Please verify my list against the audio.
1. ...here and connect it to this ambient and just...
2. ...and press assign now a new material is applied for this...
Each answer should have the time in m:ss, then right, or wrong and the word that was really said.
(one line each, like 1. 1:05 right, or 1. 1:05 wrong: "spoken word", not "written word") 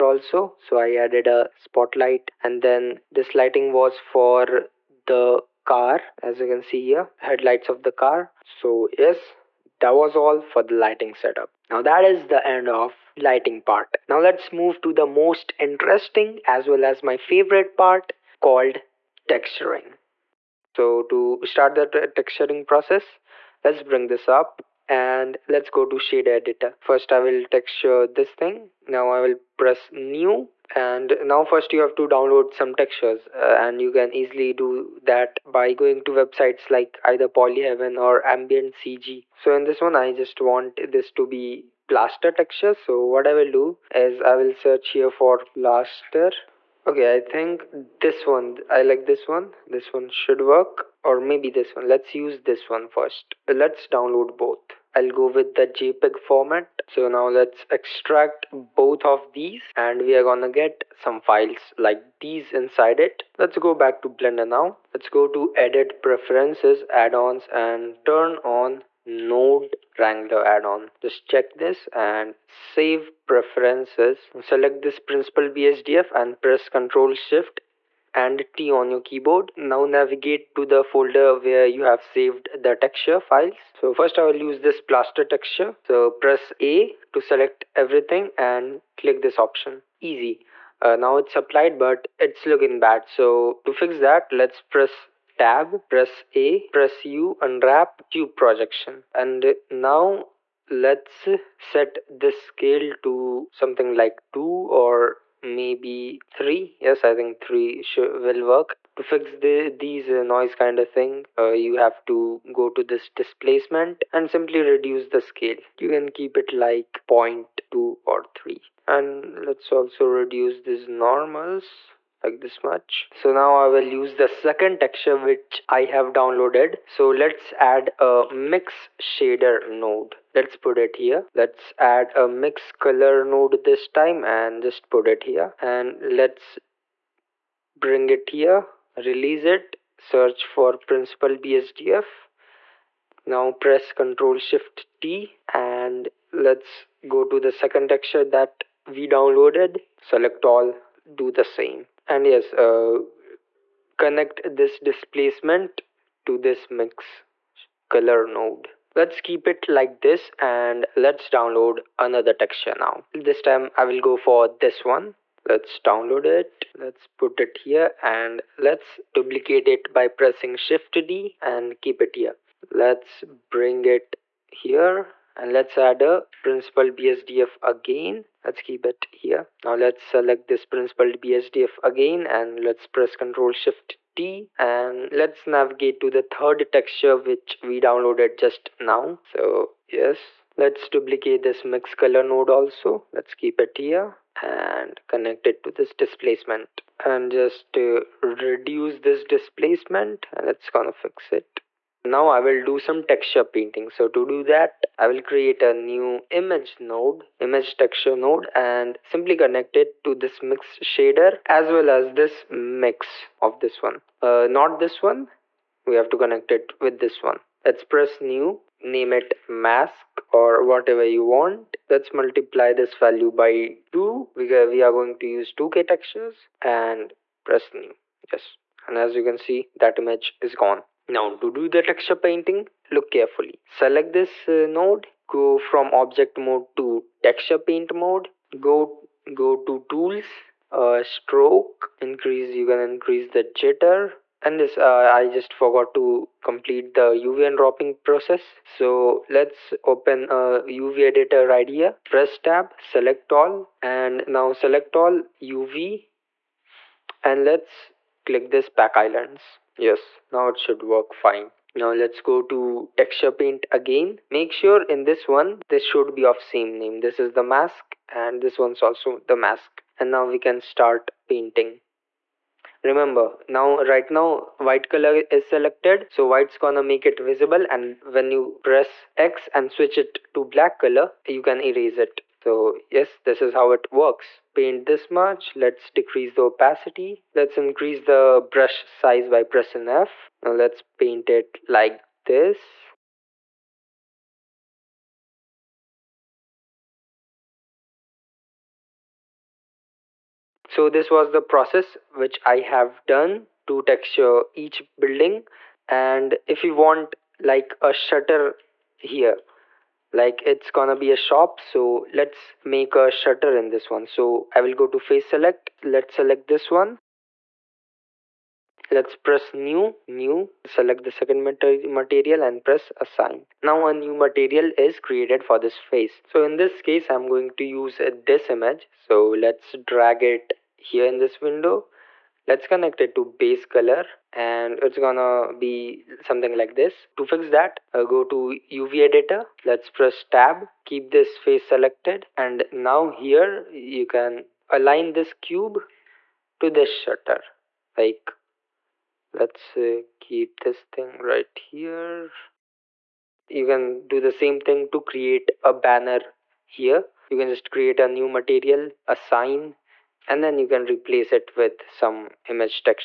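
1. 3:13 wrong: "displacement", not "ambient"
2. 5:22 wrong: "created", not "applied".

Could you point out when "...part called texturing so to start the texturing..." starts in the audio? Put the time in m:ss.
0:17.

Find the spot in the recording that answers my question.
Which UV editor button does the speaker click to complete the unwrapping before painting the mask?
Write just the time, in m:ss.
4:18.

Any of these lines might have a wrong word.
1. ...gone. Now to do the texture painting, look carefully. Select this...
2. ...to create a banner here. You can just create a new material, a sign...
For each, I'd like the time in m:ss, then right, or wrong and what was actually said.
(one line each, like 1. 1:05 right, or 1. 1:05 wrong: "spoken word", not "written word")
1. 3:50 right
2. 5:54 right.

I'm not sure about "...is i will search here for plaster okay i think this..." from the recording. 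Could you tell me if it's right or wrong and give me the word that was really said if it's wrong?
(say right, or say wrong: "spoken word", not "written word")
right.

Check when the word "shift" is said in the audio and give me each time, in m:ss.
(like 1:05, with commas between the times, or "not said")
1:17, 2:24, 2:50, 3:03.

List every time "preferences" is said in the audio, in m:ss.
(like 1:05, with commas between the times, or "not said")
1:06, 1:13.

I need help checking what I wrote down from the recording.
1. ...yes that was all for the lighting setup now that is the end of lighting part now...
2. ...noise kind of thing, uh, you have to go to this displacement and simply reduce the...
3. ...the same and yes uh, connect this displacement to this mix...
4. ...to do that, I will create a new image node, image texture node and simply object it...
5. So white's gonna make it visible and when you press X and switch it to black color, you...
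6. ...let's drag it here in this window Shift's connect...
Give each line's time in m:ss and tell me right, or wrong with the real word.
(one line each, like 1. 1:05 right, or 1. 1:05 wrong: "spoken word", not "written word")
1. 0:08 right
2. 1:50 right
3. 2:31 right
4. 3:24 wrong: "connect", not "object"
5. 4:36 right
6. 5:29 wrong: "Let", not "Shift".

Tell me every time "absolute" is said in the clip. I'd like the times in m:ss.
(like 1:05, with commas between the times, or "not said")
not said.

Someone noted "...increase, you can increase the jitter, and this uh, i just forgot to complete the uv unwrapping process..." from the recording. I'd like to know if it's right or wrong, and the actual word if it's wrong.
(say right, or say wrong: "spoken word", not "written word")
right.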